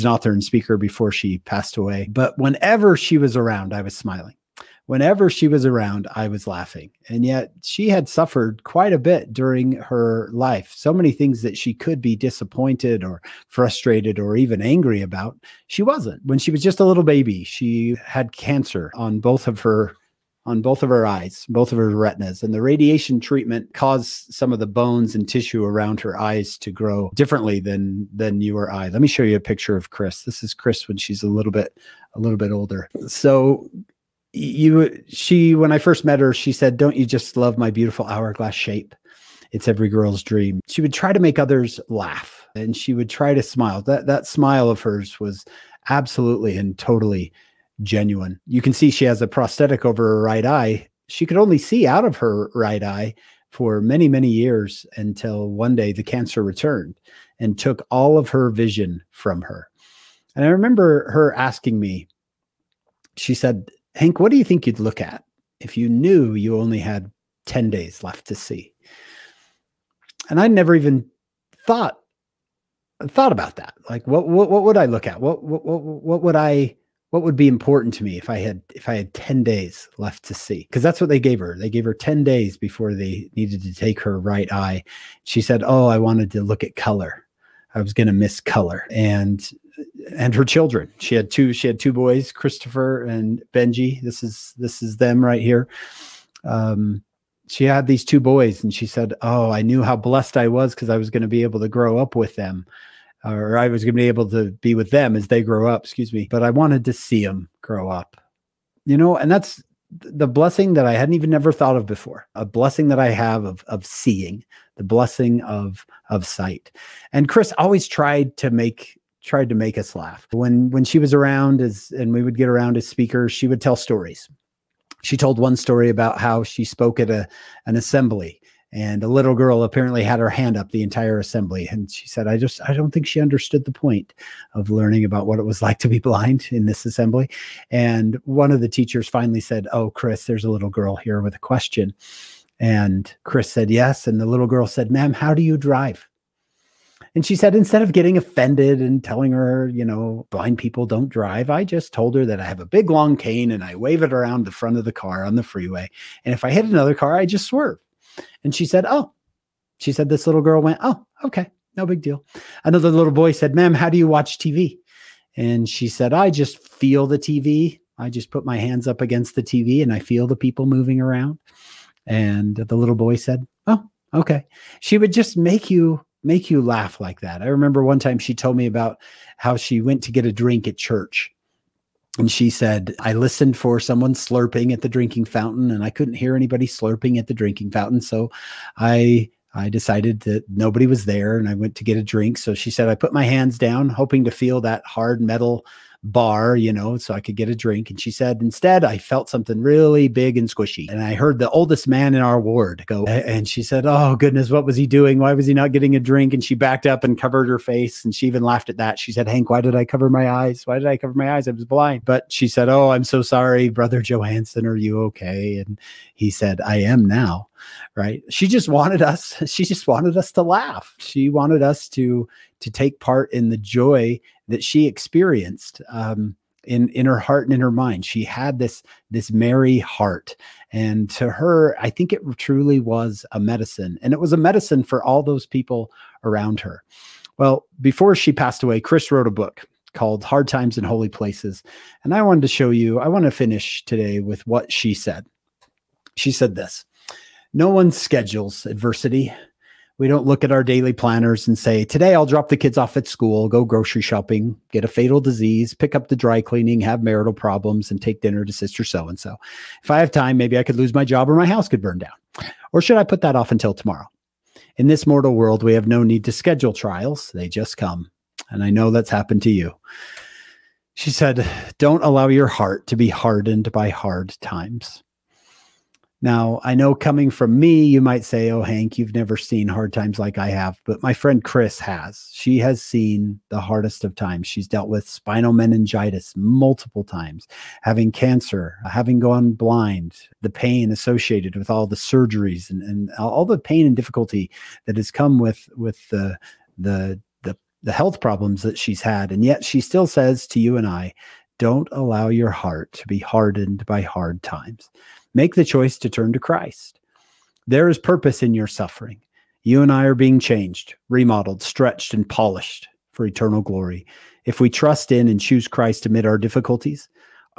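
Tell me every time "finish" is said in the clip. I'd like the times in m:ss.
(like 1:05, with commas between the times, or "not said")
4:03.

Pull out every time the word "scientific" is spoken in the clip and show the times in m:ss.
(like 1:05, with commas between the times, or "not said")
not said.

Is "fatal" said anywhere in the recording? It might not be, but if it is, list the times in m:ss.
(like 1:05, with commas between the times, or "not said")
4:14.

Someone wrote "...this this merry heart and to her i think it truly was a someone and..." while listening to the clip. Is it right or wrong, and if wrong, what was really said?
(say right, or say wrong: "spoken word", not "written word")
wrong: "medicine", not "someone".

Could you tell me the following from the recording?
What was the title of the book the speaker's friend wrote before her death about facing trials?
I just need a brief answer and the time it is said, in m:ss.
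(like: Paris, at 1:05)
Hard Times in Holy Places, at 4:00.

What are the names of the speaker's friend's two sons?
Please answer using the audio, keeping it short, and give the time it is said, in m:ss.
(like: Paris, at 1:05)
Christopher and Benji, at 1:32.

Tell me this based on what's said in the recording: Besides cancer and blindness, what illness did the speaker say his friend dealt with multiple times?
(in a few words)
spinal meningitis.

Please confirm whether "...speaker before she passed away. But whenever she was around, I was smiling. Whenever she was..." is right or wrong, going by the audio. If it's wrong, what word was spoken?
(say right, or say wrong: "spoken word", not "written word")
right.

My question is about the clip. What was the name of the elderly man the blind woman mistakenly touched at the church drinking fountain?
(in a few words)
Brother Johansson.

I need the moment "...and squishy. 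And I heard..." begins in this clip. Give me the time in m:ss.
3:20.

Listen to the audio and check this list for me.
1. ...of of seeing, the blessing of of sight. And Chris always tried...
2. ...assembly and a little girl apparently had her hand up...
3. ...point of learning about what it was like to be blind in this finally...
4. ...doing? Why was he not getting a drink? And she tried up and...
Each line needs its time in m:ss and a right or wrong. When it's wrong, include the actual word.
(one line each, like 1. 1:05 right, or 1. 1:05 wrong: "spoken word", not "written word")
1. 1:53 right
2. 2:07 right
3. 2:13 wrong: "assembly", not "finally"
4. 3:24 wrong: "backed", not "tried".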